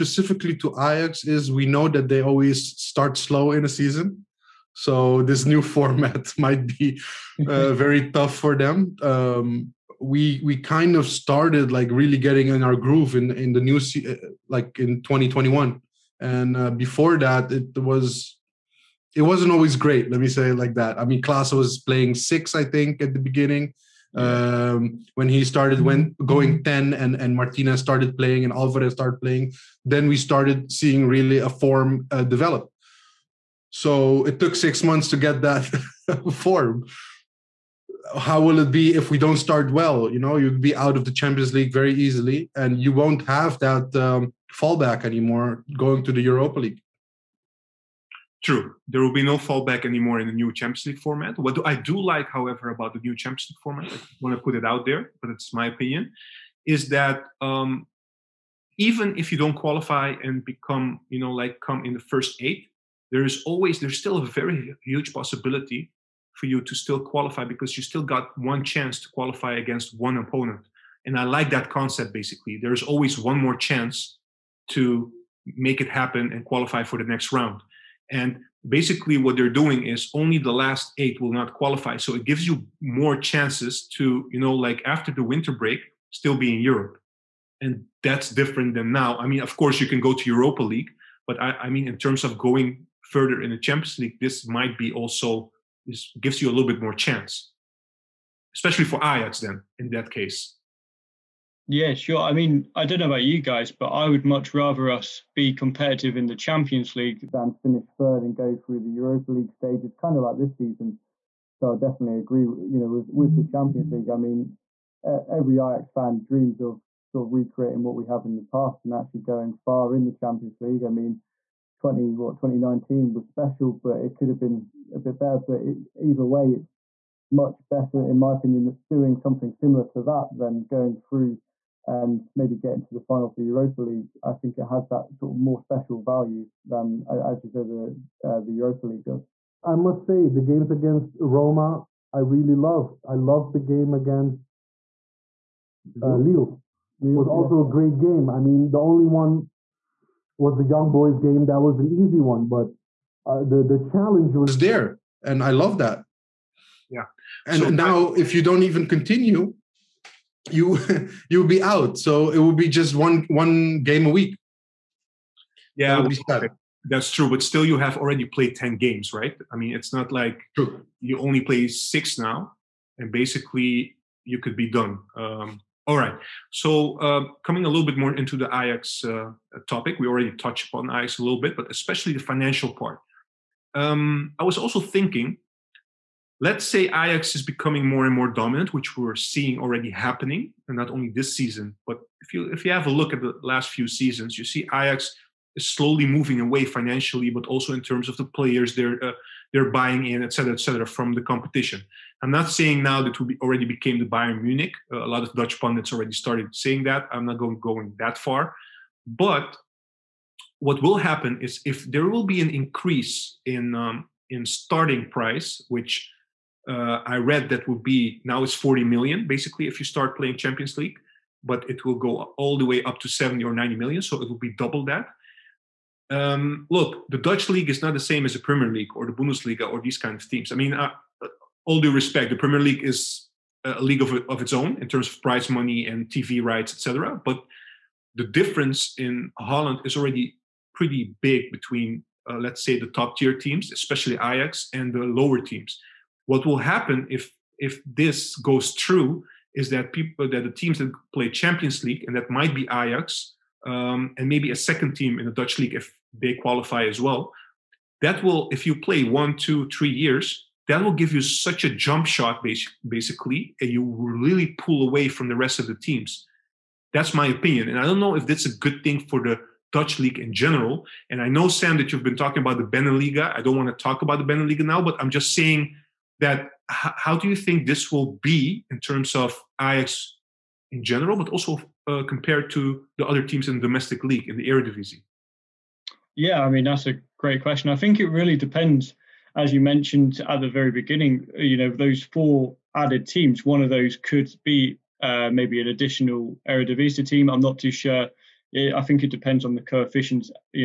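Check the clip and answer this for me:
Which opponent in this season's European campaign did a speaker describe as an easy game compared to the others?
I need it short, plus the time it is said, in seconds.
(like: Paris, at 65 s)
Young Boys, at 150 s.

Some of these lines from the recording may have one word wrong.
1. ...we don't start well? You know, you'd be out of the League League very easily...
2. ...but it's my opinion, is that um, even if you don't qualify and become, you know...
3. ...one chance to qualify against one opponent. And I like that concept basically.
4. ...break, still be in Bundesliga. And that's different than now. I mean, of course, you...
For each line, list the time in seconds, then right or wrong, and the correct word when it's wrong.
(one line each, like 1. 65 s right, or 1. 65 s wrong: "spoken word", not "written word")
1. 39 s wrong: "Champions", not "League"
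2. 55 s right
3. 68 s right
4. 85 s wrong: "Europe", not "Bundesliga".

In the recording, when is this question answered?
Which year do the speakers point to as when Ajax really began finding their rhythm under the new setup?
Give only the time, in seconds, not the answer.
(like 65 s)
15 s.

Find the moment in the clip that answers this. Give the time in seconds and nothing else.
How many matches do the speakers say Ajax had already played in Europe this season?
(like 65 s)
168 s.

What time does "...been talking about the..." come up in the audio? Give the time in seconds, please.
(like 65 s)
272 s.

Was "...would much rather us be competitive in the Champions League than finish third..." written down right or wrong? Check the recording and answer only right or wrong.
right.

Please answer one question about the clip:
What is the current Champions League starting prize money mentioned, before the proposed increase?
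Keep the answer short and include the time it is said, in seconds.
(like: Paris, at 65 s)
40 million, at 218 s.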